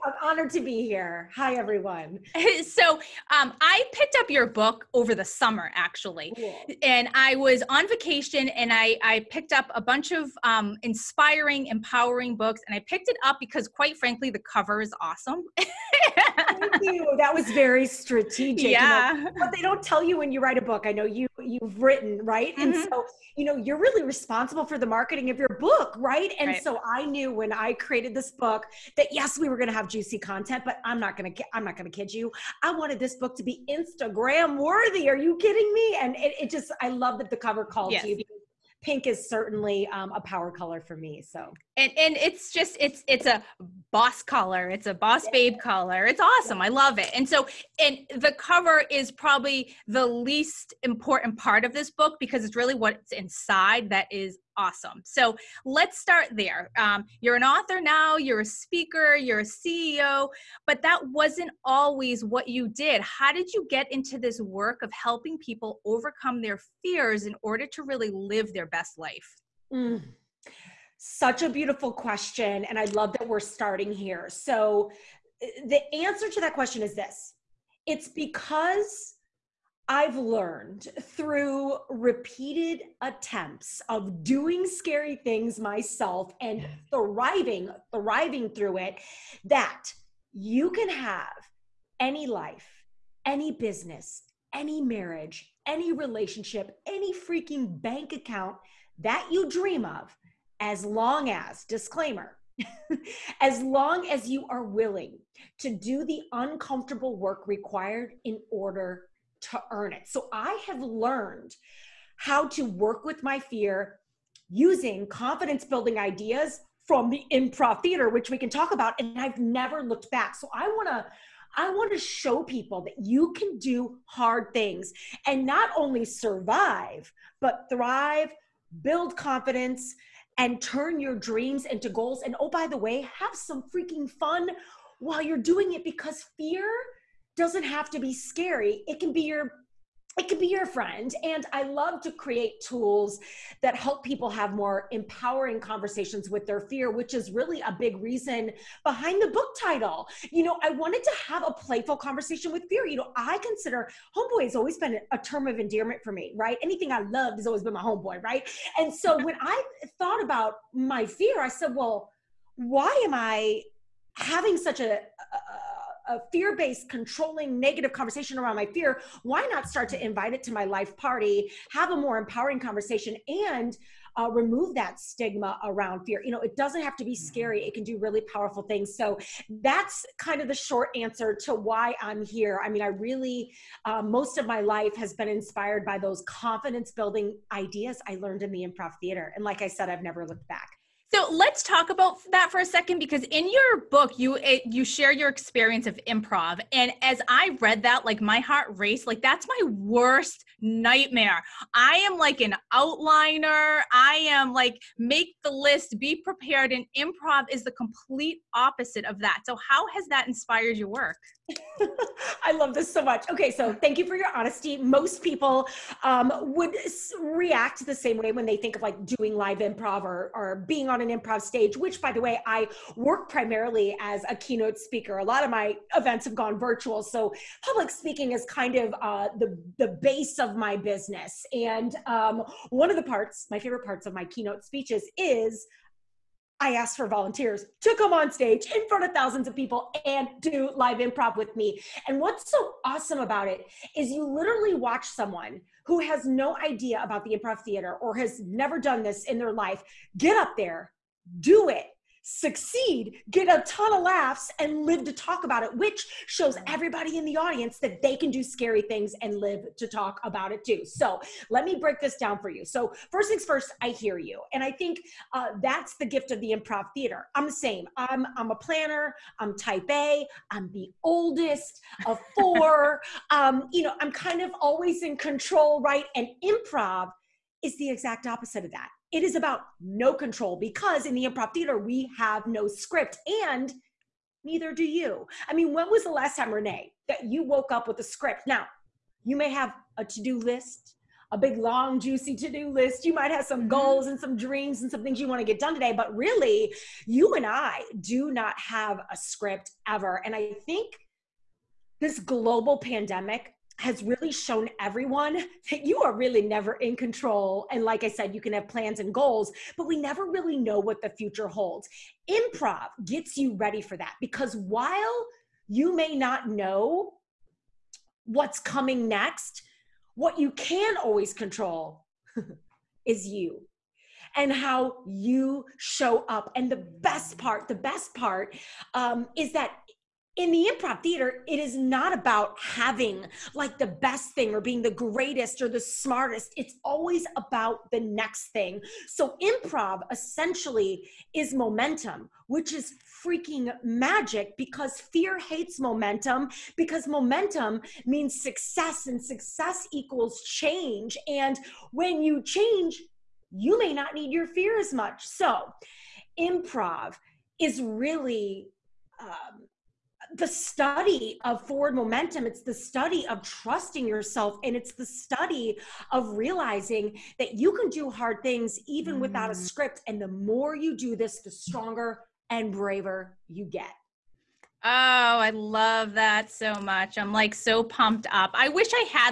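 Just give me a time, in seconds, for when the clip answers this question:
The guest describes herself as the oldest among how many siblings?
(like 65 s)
272 s.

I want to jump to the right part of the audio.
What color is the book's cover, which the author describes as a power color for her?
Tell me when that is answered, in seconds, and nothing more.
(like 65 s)
38 s.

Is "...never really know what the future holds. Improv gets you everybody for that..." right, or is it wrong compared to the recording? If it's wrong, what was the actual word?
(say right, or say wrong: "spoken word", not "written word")
wrong: "ready", not "everybody".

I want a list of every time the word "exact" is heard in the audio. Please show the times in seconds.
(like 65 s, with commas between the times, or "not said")
277 s.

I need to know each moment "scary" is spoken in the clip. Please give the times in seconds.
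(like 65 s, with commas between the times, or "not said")
84 s, 138 s, 177 s, 258 s.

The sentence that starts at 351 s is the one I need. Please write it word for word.
And when you change, you may not need your fear as much.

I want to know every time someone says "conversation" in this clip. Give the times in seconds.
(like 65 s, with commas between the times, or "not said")
145 s, 151 s, 167 s, 172 s.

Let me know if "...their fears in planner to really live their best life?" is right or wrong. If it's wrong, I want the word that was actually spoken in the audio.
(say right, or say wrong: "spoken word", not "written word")
wrong: "order", not "planner".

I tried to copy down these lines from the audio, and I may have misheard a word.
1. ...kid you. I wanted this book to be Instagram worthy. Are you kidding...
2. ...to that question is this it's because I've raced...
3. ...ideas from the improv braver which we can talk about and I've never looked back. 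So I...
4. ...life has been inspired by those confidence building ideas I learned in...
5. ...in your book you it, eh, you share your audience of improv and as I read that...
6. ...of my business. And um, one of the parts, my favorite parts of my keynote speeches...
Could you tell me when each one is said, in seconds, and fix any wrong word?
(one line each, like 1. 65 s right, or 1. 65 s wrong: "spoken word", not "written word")
1. 31 s right
2. 76 s wrong: "learned", not "raced"
3. 115 s wrong: "theater", not "braver"
4. 184 s right
5. 193 s wrong: "experience", not "audience"
6. 230 s right.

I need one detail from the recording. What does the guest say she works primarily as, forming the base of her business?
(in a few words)
Keynote speaker.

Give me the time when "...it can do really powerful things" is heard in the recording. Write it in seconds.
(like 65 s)
177 s.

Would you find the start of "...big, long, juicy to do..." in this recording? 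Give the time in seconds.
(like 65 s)
291 s.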